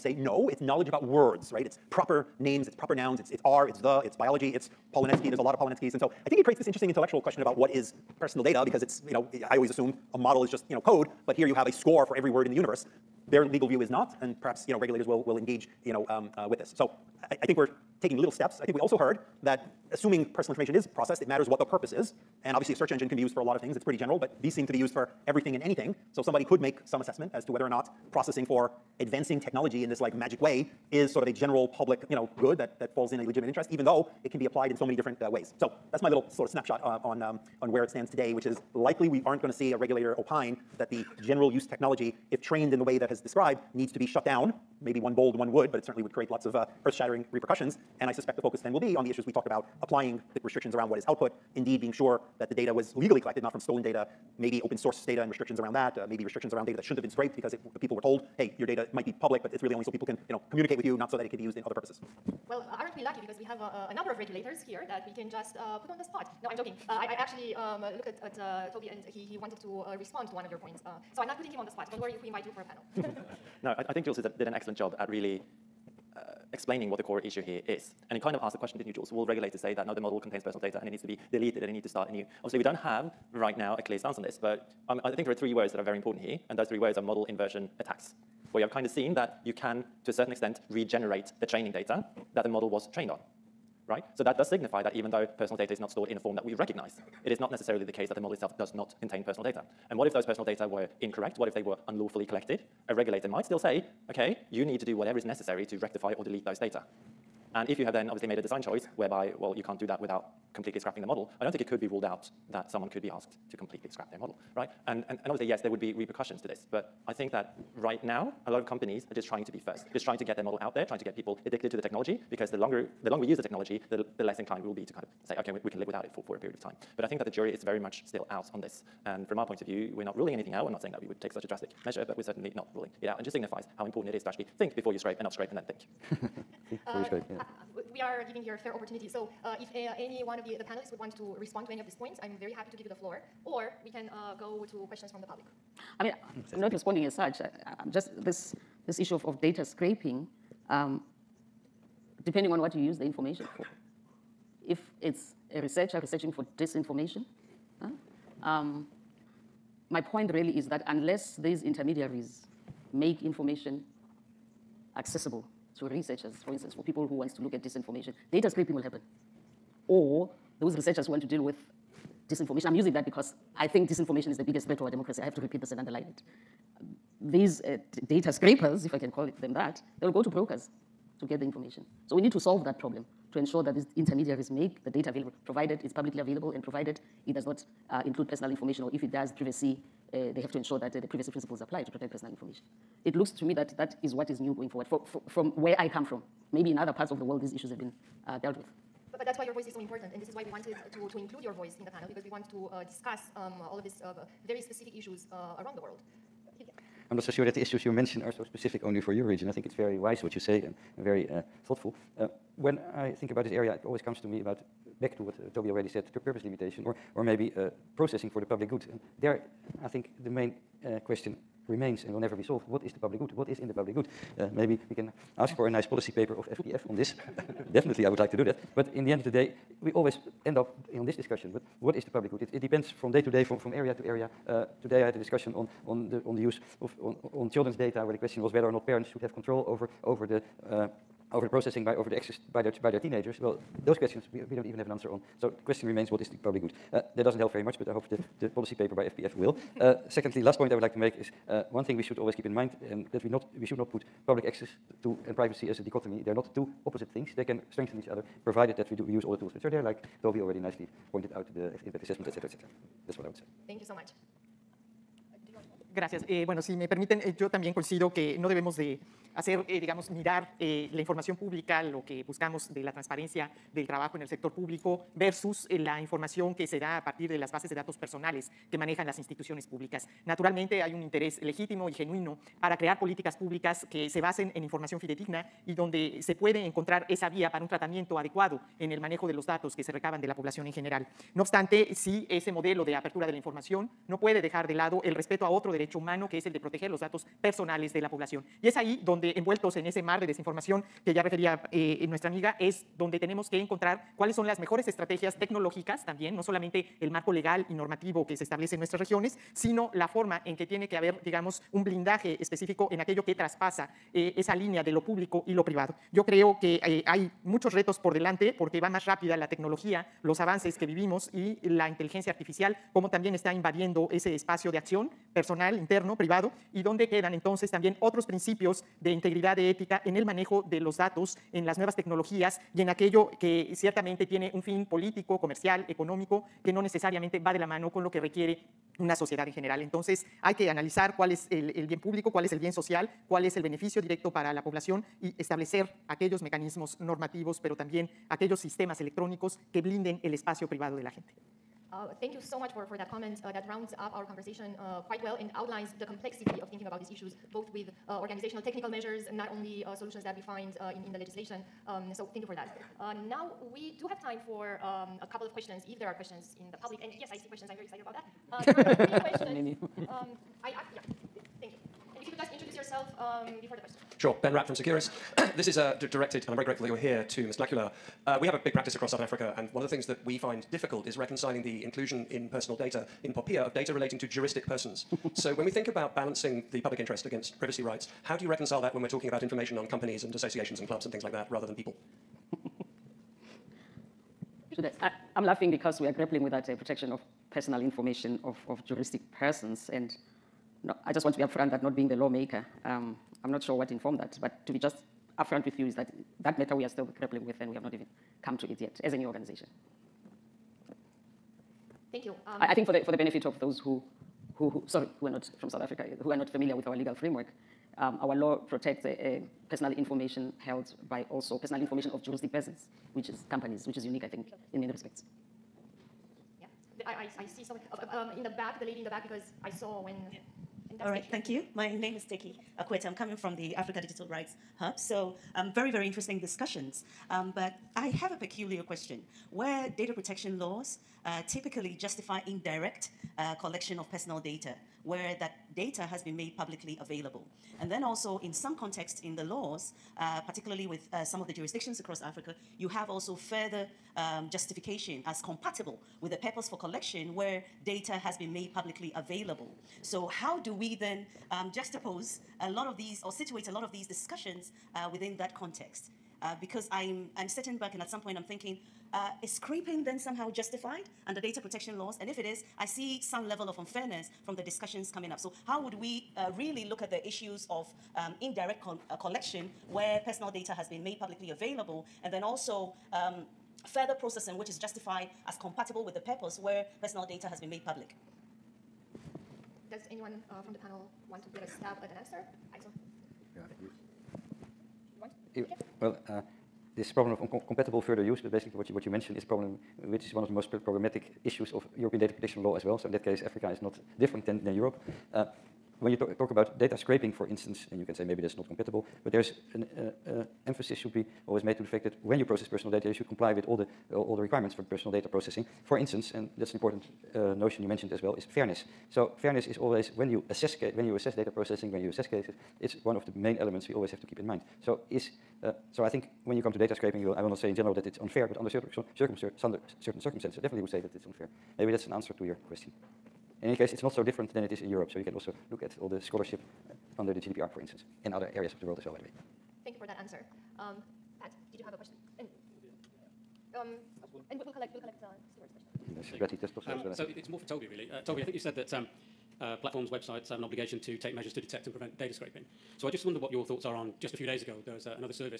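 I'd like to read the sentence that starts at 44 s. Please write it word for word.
Maybe one bold one would, but it certainly would create lots of uh, earth shattering repercussions.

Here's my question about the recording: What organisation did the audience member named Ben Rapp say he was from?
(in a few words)
Securus.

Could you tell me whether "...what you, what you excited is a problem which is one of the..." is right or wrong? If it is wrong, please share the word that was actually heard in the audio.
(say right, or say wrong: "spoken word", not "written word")
wrong: "mentioned", not "excited".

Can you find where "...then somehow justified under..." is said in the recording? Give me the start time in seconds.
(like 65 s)
470 s.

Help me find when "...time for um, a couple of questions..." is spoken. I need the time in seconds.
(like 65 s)
364 s.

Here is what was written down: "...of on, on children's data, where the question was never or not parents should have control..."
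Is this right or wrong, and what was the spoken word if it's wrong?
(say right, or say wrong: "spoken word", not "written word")
wrong: "whether", not "never".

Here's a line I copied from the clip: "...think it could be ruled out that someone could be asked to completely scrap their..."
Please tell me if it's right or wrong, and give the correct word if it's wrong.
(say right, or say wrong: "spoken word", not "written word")
right.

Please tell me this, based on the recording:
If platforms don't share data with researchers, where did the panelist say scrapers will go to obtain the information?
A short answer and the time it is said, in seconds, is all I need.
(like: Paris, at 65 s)
brokers, at 180 s.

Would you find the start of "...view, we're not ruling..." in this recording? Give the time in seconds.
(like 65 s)
129 s.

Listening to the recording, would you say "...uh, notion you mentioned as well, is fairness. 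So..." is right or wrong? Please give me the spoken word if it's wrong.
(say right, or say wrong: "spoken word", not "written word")
right.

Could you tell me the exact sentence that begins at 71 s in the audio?
Don't worry if we invite you for a panel.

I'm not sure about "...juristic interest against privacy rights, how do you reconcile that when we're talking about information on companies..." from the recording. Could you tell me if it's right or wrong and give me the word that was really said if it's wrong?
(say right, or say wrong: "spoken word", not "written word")
wrong: "public", not "juristic".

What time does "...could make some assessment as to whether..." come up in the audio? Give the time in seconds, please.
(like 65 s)
26 s.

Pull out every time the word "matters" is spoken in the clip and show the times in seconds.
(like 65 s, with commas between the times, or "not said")
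21 s, 406 s.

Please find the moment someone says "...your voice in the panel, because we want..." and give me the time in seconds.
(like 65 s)
201 s.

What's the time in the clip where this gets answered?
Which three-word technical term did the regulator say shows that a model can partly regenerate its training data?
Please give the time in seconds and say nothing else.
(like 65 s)
86 s.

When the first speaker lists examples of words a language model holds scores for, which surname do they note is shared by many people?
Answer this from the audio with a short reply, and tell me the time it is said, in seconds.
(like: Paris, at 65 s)
Polonetsky, at 4 s.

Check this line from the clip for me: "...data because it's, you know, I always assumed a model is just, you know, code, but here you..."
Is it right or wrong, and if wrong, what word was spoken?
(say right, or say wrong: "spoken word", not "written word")
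right.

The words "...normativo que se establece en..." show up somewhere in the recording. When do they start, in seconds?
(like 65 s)
307 s.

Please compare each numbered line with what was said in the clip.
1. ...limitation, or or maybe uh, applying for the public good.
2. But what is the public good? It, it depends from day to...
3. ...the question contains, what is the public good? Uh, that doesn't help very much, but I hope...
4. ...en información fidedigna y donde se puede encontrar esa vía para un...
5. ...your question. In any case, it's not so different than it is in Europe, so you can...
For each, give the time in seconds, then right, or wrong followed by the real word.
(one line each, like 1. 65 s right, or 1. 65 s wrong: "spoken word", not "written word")
1. 216 s wrong: "processing", not "applying"
2. 231 s right
3. 245 s wrong: "remains", not "contains"
4. 284 s right
5. 532 s right.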